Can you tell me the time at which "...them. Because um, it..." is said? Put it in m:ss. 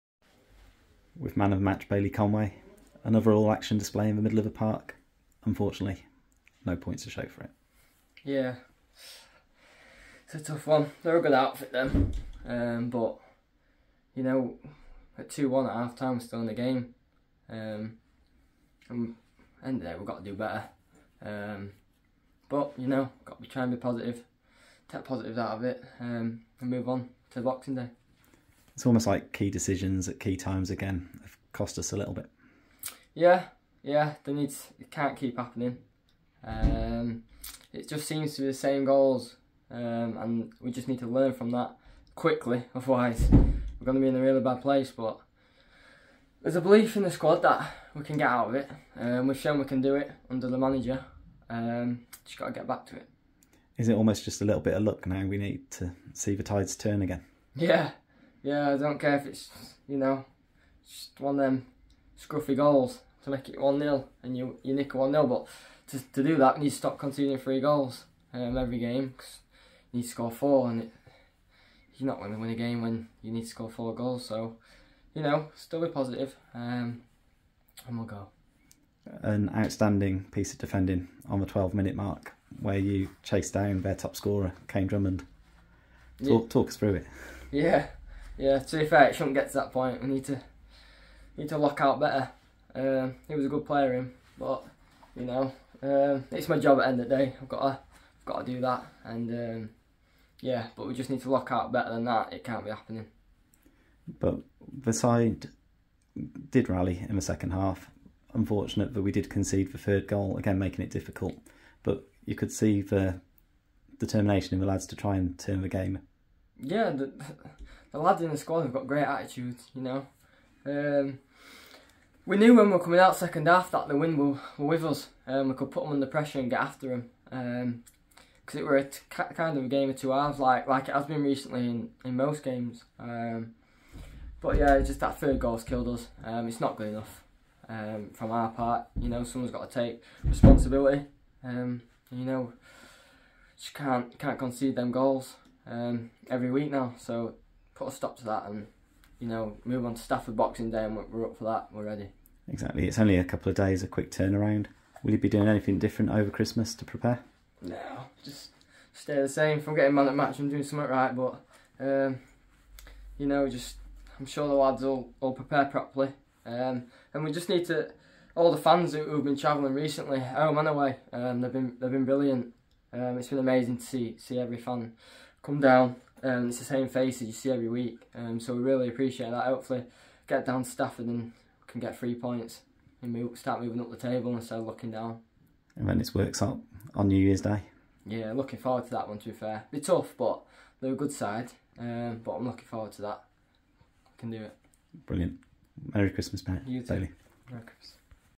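2:06.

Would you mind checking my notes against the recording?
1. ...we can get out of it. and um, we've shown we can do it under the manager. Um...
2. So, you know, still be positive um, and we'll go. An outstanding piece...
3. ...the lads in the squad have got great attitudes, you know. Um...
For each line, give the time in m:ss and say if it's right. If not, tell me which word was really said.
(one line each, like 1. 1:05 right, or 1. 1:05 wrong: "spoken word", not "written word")
1. 0:47 right
2. 1:14 right
3. 1:57 right.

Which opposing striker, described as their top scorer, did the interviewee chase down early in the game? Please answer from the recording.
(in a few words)
Kane Drummond.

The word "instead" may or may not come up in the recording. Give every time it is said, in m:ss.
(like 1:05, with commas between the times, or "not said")
3:04.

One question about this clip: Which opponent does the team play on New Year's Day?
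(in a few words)
Worksop.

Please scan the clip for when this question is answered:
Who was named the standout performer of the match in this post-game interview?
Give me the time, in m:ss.
0:01.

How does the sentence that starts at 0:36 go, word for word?
Um, it just seems to be the same goals, um, and we just need to learn from that quickly.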